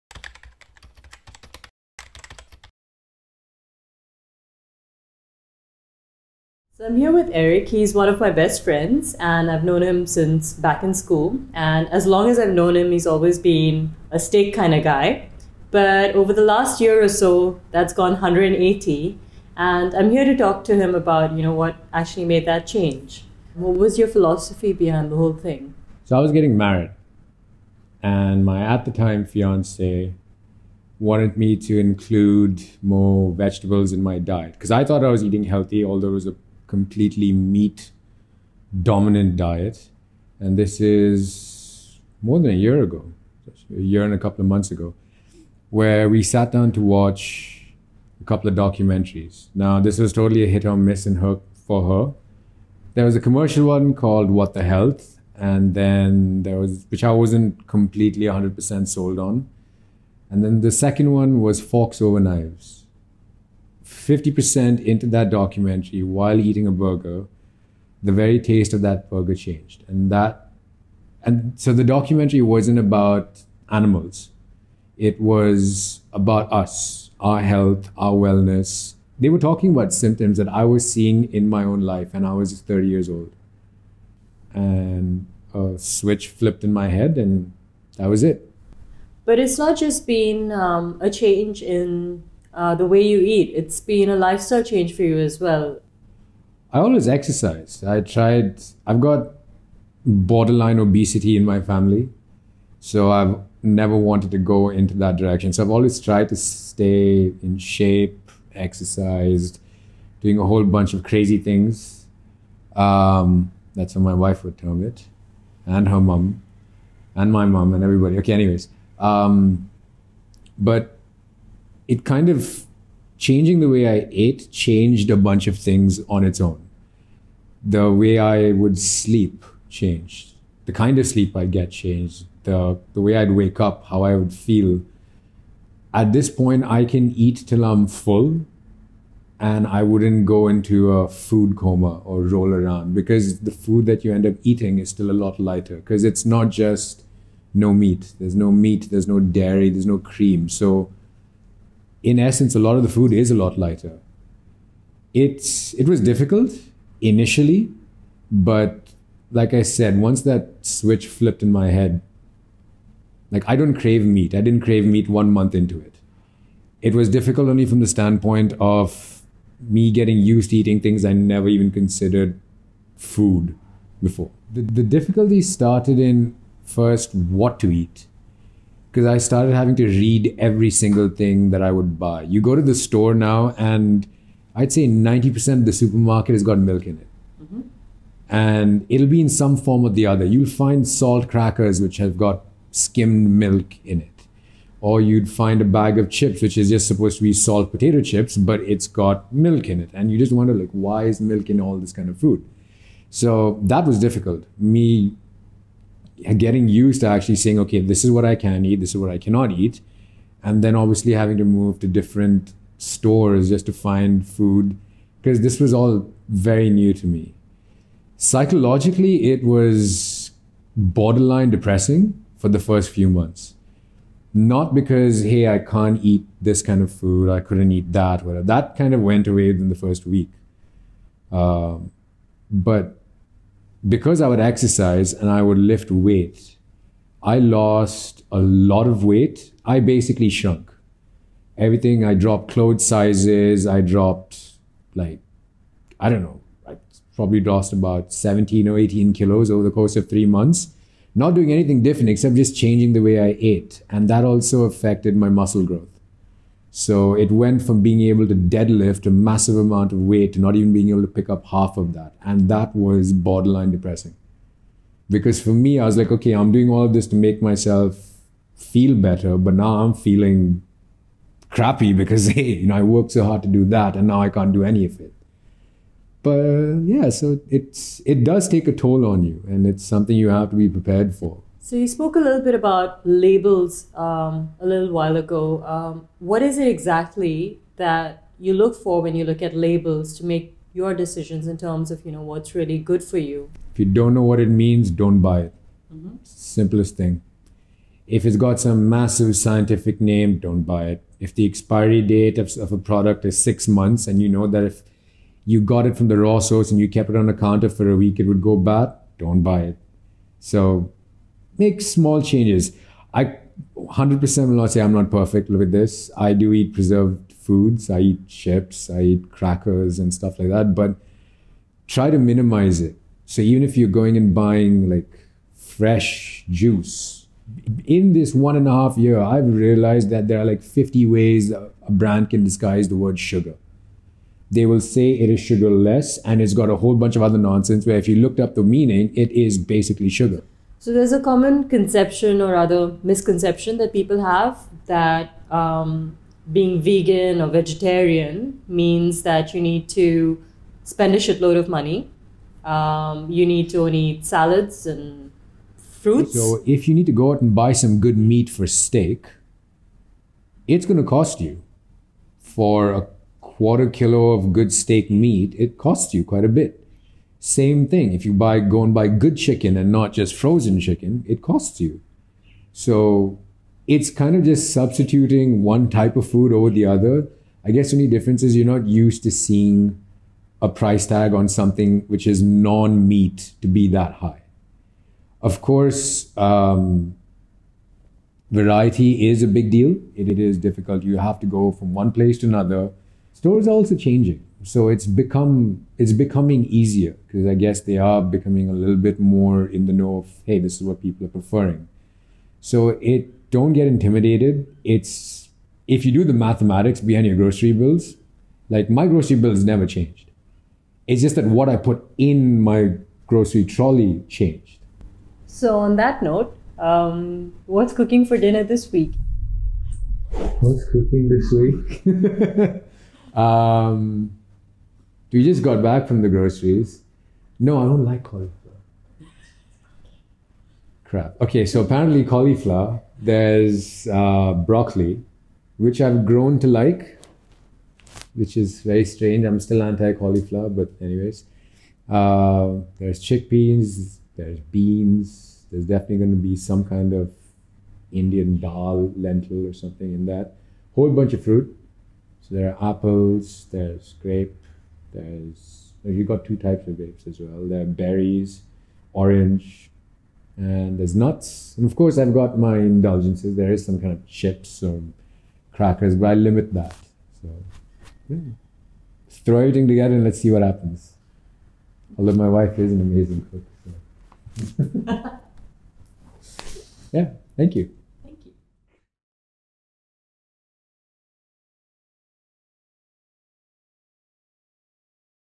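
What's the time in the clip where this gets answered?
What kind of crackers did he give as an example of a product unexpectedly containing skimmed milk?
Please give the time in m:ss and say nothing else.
3:10.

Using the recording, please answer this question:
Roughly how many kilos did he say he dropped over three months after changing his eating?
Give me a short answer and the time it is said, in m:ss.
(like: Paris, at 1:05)
17 or 18 kilos, at 4:08.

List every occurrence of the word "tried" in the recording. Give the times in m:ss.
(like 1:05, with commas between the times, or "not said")
1:38, 1:45.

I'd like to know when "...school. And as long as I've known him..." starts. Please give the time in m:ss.
0:10.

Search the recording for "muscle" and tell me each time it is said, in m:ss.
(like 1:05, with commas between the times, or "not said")
4:15.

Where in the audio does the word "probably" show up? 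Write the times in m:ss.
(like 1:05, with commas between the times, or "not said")
4:07.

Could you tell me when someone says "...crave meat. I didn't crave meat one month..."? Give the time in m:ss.
2:43.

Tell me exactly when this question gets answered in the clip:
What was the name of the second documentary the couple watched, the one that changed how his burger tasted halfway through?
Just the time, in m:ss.
1:01.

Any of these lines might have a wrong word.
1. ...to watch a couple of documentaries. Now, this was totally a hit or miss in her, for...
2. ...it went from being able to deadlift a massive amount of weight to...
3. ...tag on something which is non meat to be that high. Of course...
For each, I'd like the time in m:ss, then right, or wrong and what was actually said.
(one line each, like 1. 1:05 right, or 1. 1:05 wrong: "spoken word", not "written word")
1. 0:46 right
2. 4:17 right
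3. 6:21 right.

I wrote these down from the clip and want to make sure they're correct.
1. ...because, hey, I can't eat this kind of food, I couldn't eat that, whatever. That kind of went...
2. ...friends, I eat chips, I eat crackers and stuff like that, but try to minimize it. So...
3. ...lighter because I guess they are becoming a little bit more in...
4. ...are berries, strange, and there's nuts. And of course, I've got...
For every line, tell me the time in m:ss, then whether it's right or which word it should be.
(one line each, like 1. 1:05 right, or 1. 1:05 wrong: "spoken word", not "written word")
1. 3:44 right
2. 5:17 wrong: "foods", not "friends"
3. 6:36 wrong: "easier", not "lighter"
4. 7:37 wrong: "orange", not "strange".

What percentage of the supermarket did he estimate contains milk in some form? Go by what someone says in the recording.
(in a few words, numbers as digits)
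90%.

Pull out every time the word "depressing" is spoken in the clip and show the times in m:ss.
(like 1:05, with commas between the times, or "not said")
3:41, 4:23.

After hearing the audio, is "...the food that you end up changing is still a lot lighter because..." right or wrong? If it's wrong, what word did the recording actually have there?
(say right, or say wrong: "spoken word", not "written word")
wrong: "eating", not "changing".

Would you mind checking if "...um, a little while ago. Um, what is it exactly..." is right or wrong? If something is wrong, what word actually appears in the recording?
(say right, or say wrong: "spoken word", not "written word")
right.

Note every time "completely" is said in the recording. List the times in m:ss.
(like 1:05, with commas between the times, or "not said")
0:36, 0:57.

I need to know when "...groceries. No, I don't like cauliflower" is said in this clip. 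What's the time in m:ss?
7:06.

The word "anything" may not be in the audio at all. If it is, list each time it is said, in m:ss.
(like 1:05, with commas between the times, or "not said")
4:11.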